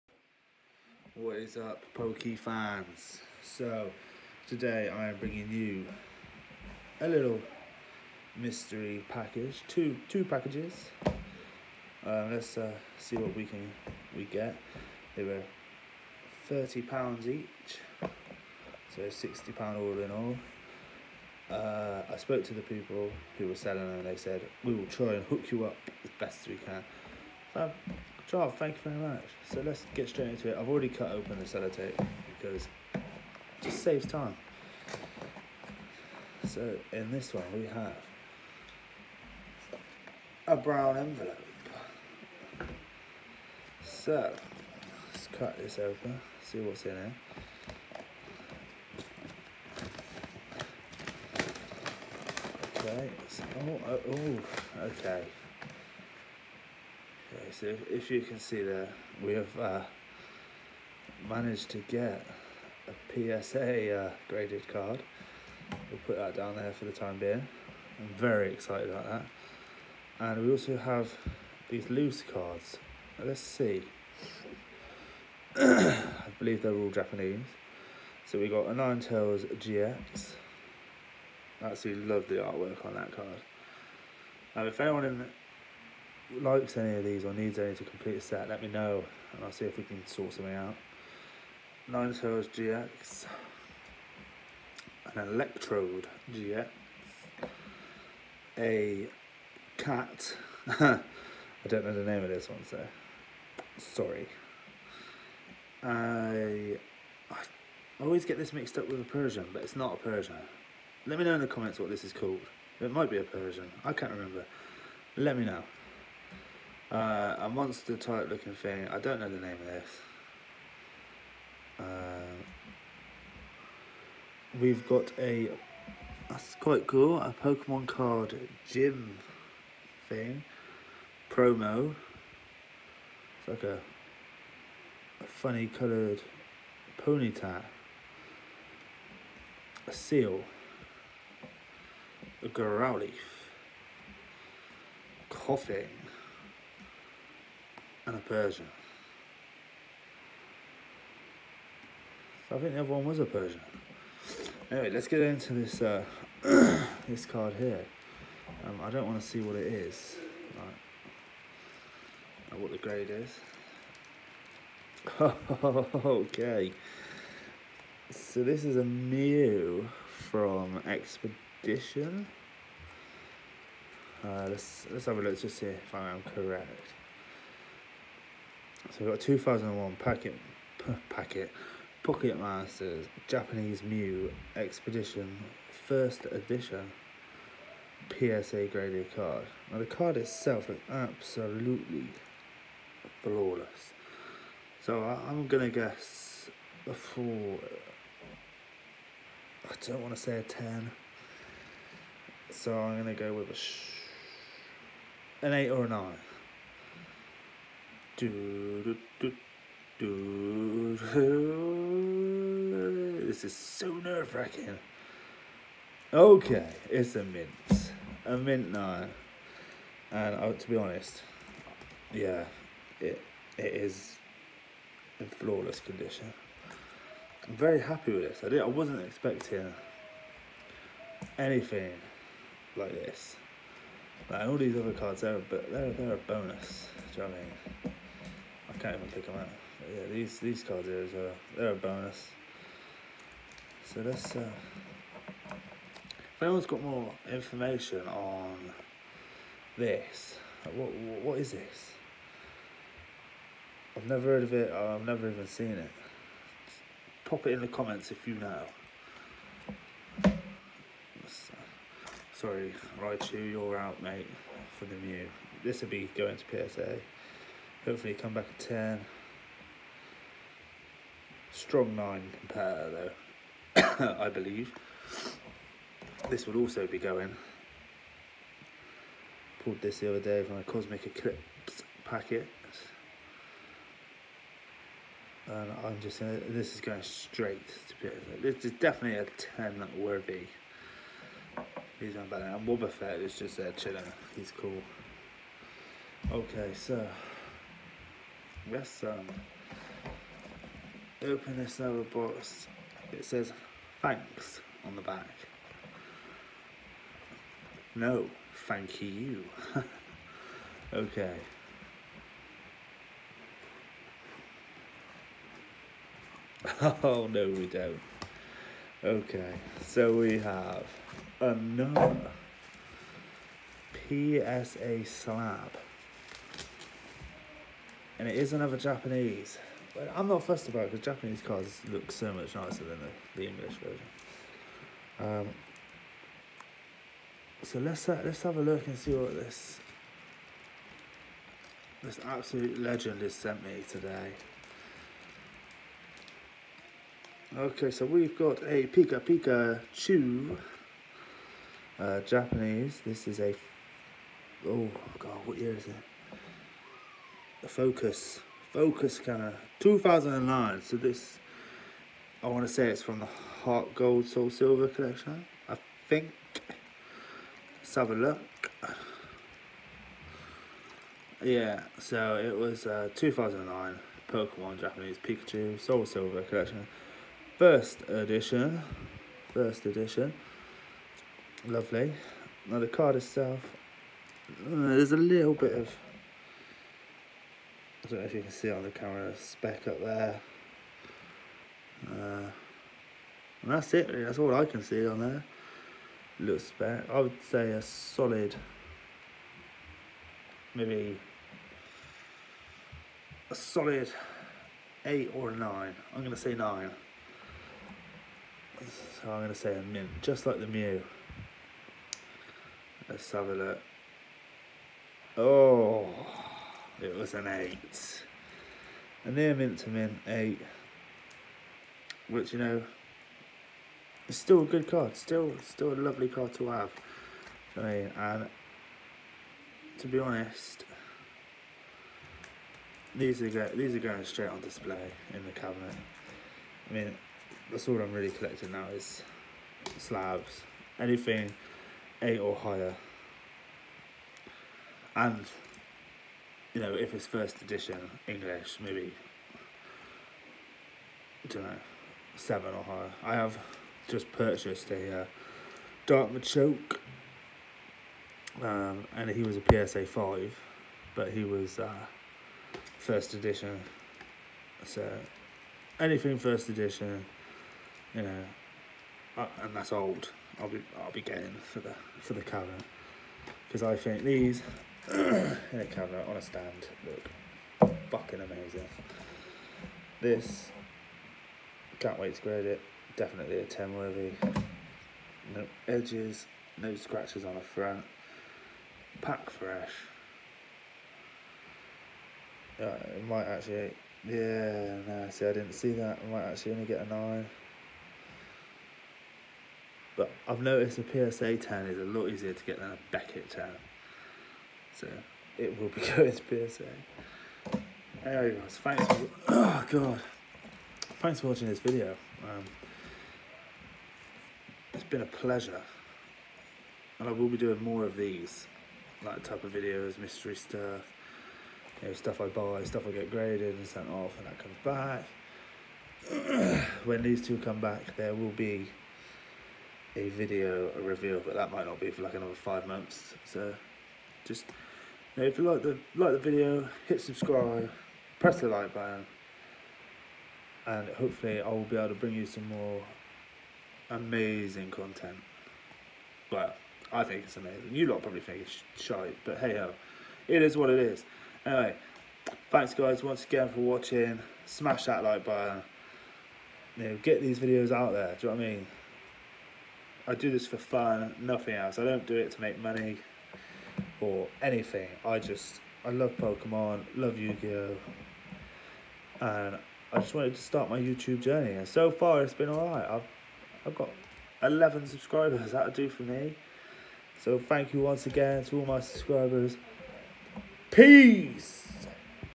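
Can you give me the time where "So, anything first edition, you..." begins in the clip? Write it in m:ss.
7:44.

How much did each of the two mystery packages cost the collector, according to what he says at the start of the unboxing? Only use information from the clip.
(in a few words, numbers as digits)
30 pounds.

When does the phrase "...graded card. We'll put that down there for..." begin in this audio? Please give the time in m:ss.
1:04.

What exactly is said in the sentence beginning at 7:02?
Which, you know, it's still a good card.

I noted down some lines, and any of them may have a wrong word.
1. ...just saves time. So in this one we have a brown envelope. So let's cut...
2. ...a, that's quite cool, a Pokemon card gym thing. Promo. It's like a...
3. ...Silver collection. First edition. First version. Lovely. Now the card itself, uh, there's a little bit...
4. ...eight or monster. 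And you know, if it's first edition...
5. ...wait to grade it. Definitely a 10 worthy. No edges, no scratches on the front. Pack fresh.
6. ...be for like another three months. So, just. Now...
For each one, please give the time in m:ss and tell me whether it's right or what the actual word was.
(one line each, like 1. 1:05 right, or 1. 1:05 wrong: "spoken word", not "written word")
1. 0:33 right
2. 2:05 right
3. 6:16 wrong: "edition", not "version"
4. 7:22 wrong: "higher", not "monster"
5. 8:02 right
6. 8:51 wrong: "five", not "three".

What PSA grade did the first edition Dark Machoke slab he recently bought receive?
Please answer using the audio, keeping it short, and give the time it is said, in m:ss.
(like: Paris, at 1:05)
5, at 7:39.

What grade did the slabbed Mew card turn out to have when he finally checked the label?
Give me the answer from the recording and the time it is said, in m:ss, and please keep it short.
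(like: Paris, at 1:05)
9, at 3:38.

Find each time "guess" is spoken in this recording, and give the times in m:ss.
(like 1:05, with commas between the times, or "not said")
3:15.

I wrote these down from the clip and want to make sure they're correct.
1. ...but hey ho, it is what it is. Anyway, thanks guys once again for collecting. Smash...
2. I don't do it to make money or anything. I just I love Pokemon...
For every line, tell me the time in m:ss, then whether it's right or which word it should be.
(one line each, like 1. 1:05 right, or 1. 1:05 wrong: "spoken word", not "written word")
1. 9:09 wrong: "watching", not "collecting"
2. 9:21 right.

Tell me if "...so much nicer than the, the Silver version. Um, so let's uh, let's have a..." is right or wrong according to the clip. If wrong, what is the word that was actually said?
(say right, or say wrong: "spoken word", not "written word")
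wrong: "English", not "Silver".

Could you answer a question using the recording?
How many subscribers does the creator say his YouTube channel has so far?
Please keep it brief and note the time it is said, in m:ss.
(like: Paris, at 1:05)
11, at 9:34.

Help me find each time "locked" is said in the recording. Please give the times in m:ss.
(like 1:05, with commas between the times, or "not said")
not said.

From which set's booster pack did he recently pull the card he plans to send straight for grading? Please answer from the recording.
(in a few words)
Cosmic Eclipse.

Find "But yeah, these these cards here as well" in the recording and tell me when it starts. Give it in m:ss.
3:59.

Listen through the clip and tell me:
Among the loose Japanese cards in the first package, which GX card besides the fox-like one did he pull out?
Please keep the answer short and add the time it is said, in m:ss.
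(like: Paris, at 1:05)
Electrode GX, at 1:35.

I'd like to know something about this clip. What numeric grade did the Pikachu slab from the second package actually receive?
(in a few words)
8.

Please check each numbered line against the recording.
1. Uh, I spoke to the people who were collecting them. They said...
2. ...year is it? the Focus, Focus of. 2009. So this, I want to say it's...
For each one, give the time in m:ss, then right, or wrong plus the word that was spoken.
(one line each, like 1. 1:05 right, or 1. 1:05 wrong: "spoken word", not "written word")
1. 0:21 wrong: "selling", not "collecting"
2. 5:55 right.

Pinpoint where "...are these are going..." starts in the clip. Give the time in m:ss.
7:13.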